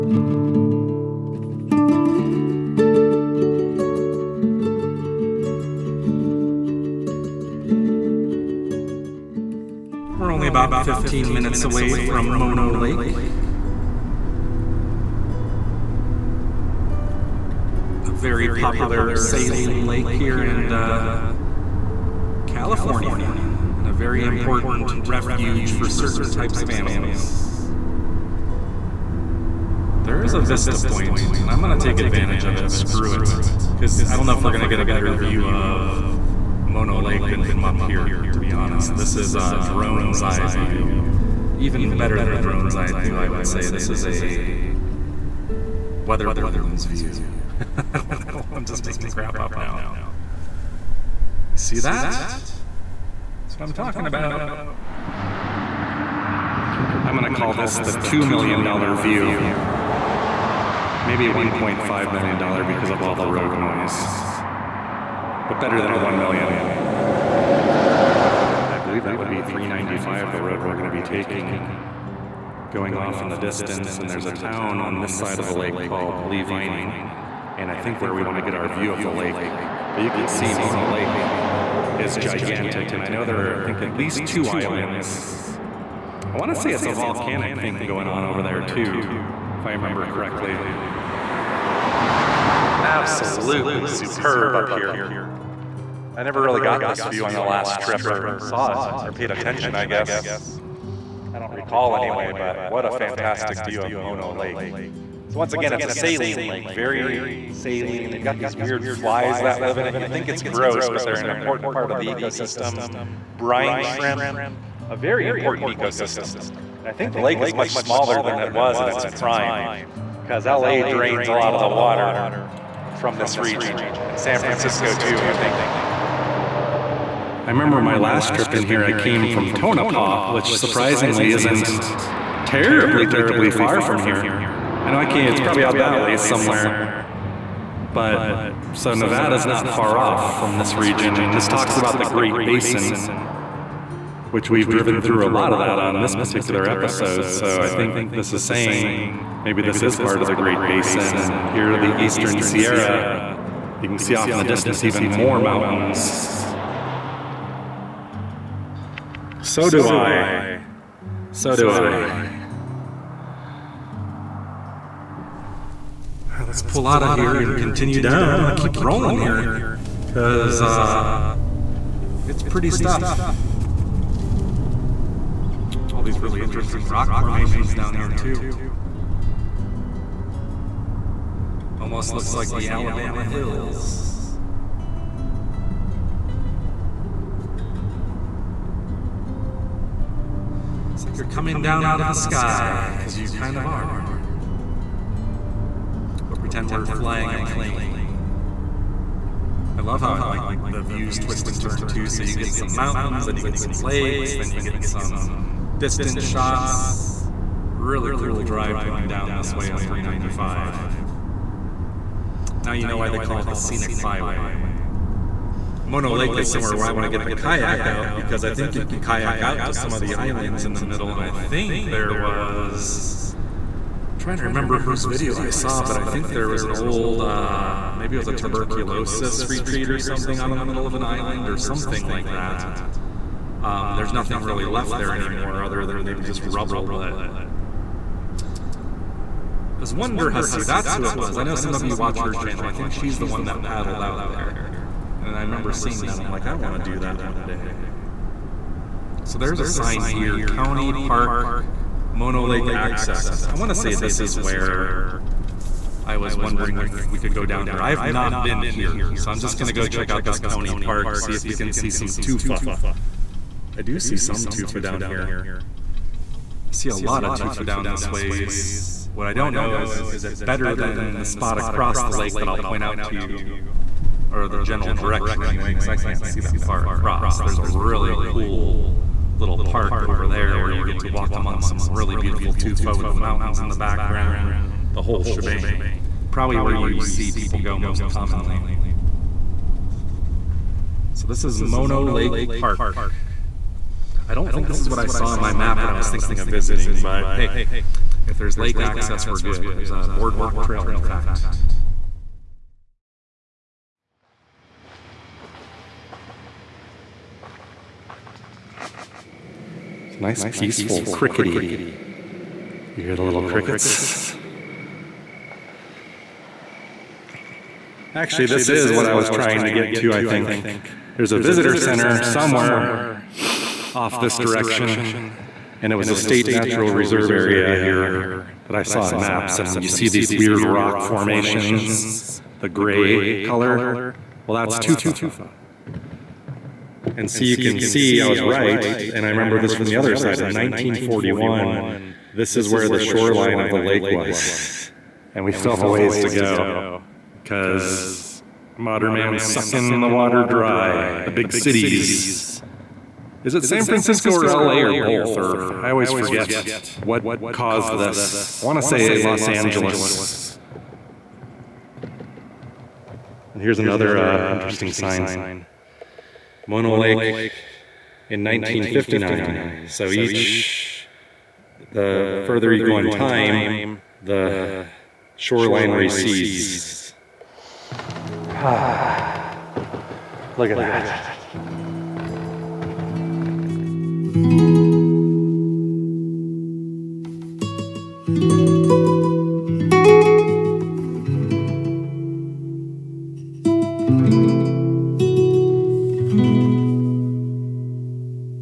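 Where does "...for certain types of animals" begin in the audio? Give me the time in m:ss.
0:25.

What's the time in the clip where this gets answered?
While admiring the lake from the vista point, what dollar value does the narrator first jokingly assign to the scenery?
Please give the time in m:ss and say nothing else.
0:58.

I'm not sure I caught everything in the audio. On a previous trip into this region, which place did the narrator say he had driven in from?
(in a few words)
Tonopah.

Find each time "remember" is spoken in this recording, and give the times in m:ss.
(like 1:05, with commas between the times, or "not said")
1:29, 2:07, 3:44, 4:05, 5:39.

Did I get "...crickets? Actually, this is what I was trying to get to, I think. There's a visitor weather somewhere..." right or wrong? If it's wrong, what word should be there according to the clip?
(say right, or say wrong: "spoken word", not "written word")
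wrong: "center", not "weather".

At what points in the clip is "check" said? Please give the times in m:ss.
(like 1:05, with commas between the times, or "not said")
4:19.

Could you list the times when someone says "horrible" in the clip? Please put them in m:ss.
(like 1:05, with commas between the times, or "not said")
not said.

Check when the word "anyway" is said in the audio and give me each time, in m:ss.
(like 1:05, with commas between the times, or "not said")
1:41, 4:35.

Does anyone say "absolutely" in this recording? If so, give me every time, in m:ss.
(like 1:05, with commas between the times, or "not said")
1:32.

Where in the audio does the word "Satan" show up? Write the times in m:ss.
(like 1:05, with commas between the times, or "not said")
not said.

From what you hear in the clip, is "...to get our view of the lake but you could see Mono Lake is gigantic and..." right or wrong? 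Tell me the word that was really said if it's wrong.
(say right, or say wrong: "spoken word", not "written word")
right.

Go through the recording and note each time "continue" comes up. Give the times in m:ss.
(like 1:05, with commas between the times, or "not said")
2:47.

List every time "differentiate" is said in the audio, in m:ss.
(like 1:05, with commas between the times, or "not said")
not said.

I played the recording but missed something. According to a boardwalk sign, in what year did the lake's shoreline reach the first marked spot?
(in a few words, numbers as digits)
1941.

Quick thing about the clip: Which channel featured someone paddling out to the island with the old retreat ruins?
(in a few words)
Wonder Hussy.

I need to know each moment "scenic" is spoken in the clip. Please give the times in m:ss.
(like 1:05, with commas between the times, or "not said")
3:33.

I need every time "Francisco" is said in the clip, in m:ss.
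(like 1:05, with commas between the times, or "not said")
2:04, 5:53.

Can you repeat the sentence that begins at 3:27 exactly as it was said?
Really cool drive going down this way on 395.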